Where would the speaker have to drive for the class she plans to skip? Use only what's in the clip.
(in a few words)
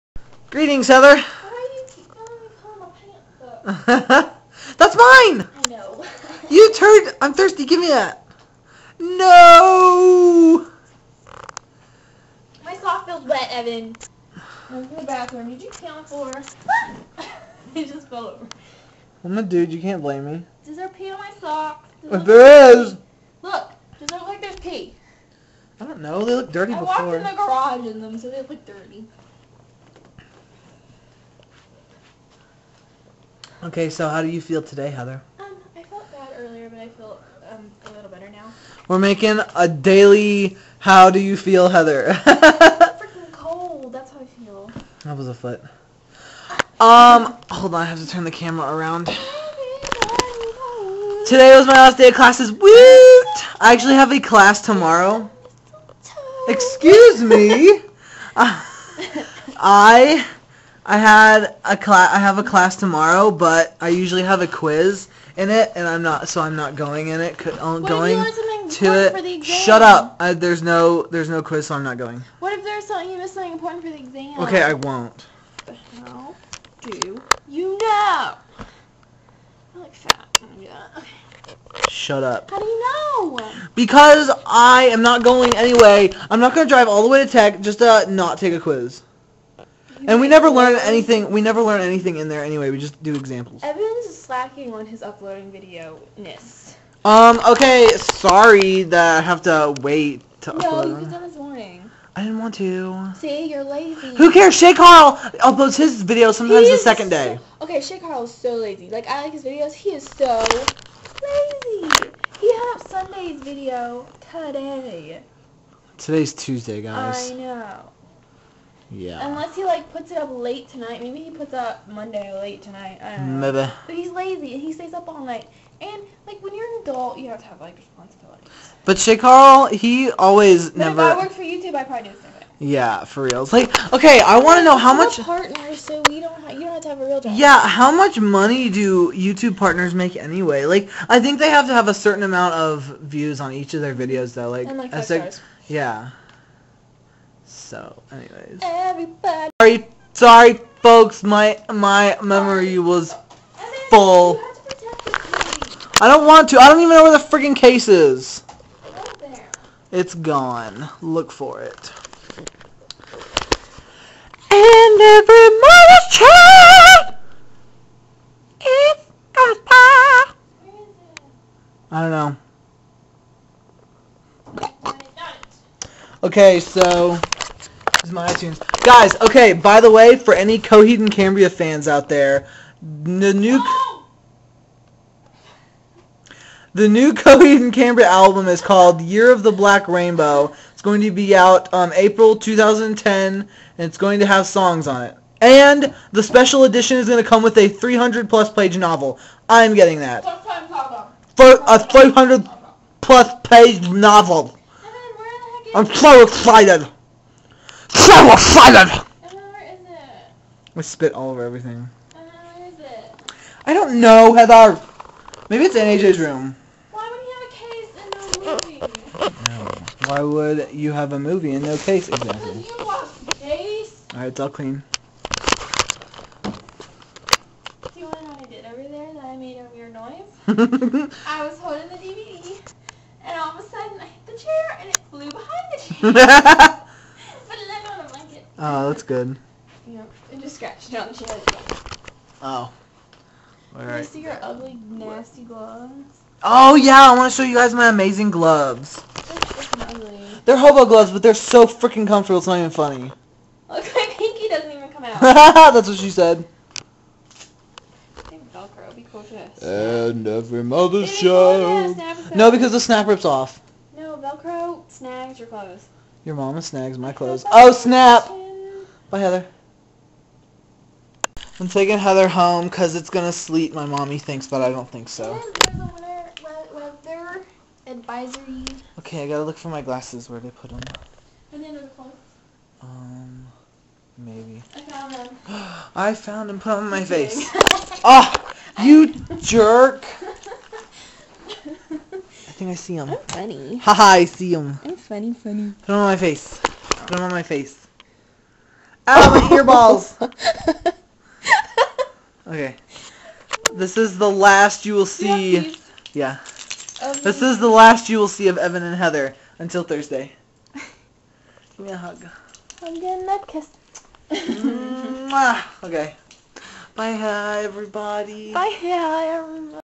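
Tech.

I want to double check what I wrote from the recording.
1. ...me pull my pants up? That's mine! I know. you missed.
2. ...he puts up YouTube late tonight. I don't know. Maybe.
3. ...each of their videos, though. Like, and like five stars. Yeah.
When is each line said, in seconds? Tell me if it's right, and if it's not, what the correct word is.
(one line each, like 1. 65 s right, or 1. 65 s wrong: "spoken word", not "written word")
1. 2 s wrong: "turned", not "missed"
2. 121 s wrong: "Monday", not "YouTube"
3. 143 s right.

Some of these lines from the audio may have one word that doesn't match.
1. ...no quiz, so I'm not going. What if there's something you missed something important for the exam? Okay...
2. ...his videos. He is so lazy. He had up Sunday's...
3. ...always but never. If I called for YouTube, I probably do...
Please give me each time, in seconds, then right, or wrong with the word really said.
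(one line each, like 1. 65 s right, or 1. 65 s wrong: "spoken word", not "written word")
1. 71 s right
2. 109 s right
3. 130 s wrong: "worked", not "called".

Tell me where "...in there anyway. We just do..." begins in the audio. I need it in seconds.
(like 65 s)
92 s.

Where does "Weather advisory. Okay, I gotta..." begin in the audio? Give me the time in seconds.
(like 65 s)
276 s.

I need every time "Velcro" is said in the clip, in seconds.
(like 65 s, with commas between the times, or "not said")
258 s, 264 s.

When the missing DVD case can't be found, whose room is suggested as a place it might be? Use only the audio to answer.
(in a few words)
AJ's room.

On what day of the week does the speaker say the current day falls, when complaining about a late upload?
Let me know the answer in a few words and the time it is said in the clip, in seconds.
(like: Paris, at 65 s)
Tuesday, at 116 s.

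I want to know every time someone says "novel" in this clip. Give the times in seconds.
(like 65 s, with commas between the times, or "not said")
198 s, 203 s.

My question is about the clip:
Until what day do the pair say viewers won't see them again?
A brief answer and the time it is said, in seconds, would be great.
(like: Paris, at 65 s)
Thursday, at 309 s.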